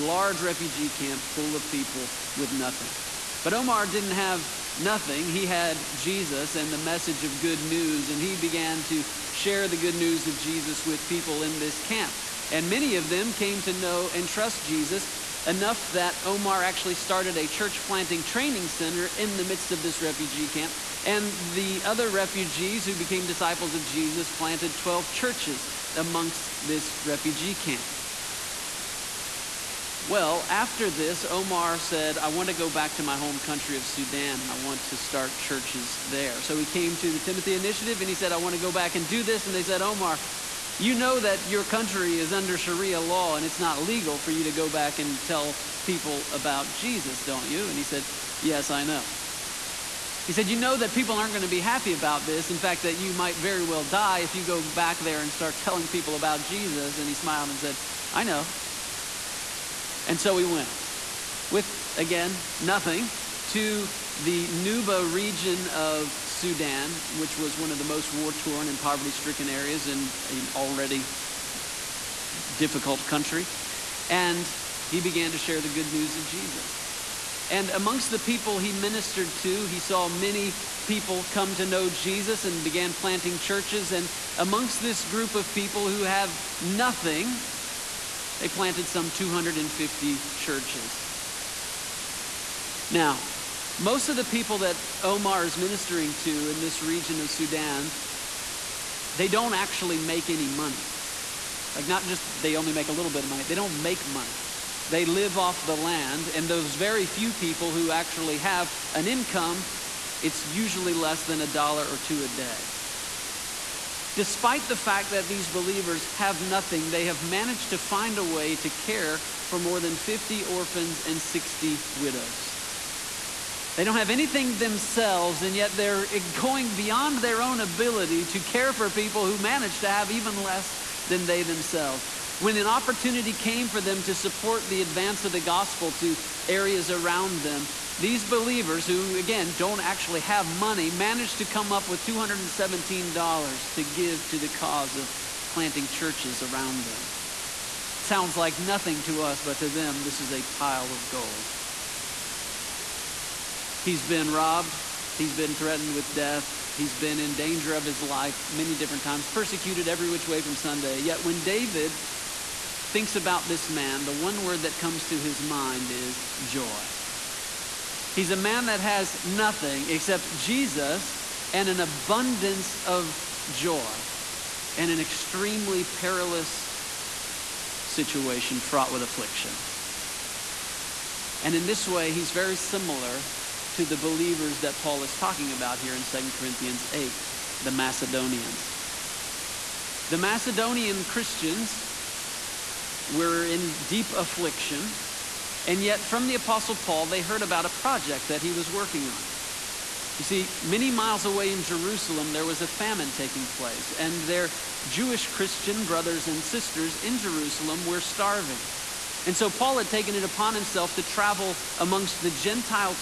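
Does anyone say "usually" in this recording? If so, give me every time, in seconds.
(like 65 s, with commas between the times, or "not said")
110 s.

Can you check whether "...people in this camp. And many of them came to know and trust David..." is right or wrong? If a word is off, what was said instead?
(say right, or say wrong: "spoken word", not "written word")
wrong: "Jesus", not "David".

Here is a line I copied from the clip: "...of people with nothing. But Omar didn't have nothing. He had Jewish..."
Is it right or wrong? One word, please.
wrong.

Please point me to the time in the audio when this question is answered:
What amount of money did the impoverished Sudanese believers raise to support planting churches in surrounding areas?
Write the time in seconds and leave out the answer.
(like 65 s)
142 s.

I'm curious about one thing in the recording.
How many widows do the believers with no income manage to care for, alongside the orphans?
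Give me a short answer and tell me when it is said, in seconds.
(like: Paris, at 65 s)
60, at 121 s.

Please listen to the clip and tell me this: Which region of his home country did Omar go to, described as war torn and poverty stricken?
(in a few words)
Nuba.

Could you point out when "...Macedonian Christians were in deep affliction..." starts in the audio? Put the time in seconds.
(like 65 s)
190 s.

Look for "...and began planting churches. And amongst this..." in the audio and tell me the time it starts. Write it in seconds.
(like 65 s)
82 s.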